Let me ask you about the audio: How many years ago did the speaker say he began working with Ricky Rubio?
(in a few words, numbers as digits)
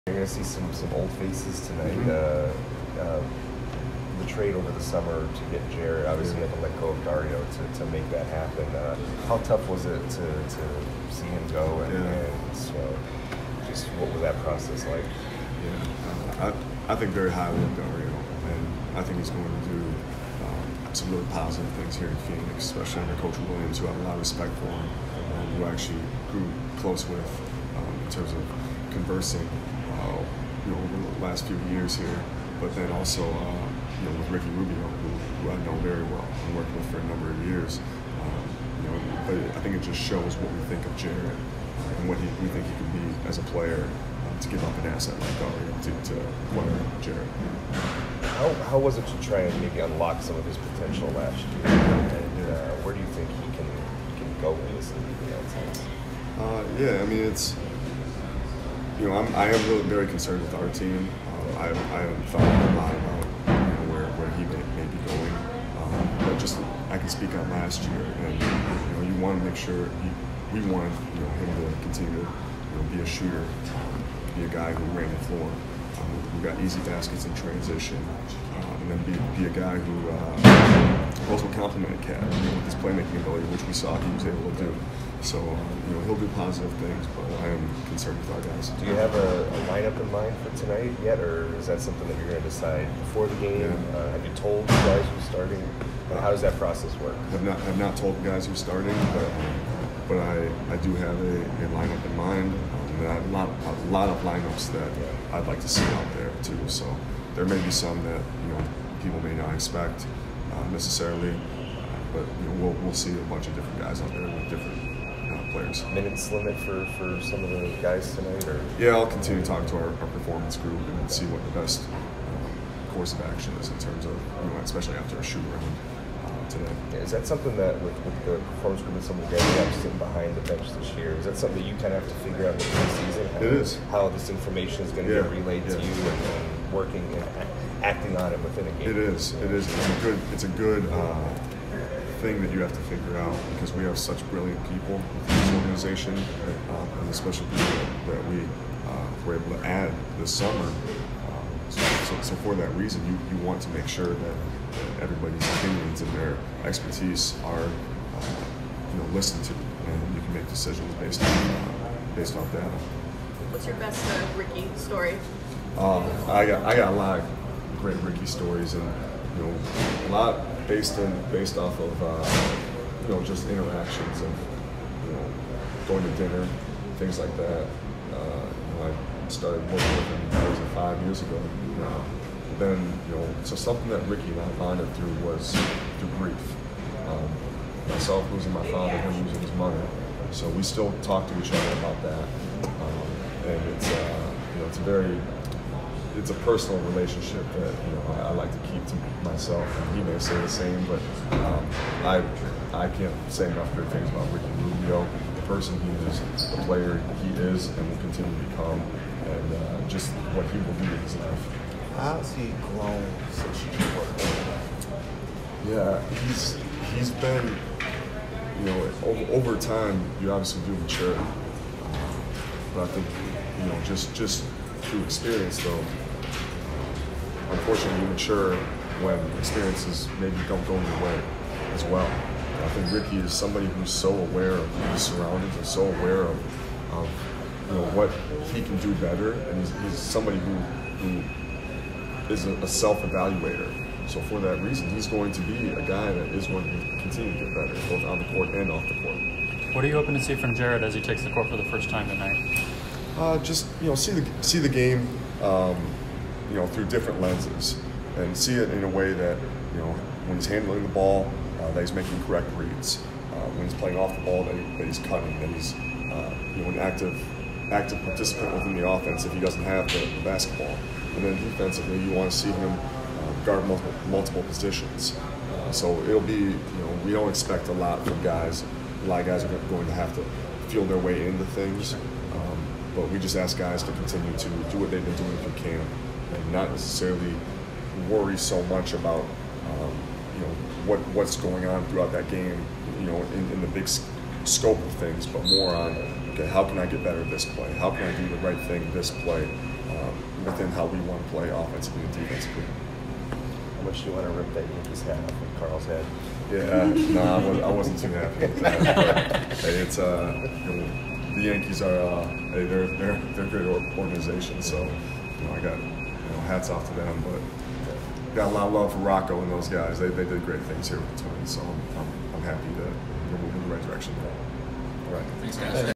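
5.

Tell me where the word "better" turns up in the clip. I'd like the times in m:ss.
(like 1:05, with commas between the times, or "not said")
3:58, 4:07, 4:57.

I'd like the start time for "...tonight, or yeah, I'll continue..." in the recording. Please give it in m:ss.
1:58.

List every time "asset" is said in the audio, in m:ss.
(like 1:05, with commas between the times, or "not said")
0:44.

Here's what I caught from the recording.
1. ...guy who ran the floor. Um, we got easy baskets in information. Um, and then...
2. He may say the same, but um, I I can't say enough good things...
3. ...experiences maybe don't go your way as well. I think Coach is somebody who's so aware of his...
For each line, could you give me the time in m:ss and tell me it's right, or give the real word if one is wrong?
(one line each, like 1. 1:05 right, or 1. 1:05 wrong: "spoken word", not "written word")
1. 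1:14 wrong: "transition", not "information"
2. 3:19 right
3. 3:49 wrong: "Ricky", not "Coach".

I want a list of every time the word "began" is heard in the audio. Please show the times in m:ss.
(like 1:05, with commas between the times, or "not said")
not said.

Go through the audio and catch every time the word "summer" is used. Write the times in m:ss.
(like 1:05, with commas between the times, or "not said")
0:04, 2:30.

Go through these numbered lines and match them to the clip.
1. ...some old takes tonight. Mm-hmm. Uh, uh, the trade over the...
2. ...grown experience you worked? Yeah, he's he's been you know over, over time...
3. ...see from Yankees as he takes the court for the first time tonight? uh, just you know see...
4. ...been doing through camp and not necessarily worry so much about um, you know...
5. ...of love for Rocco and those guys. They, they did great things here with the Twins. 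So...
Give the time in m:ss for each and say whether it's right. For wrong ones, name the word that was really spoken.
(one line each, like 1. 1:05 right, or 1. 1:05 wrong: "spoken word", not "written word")
1. 0:00 wrong: "faces", not "takes"
2. 3:32 wrong: "since", not "experience"
3. 4:10 wrong: "Jarrett", not "Yankees"
4. 4:45 right
5. 5:18 right.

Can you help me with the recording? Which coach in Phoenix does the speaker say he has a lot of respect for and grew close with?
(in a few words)
Coach Williams.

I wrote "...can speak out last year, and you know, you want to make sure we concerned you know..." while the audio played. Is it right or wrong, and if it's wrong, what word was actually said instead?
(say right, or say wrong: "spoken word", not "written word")
wrong: "wanted", not "concerned".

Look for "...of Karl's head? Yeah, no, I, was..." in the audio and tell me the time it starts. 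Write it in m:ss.
5:05.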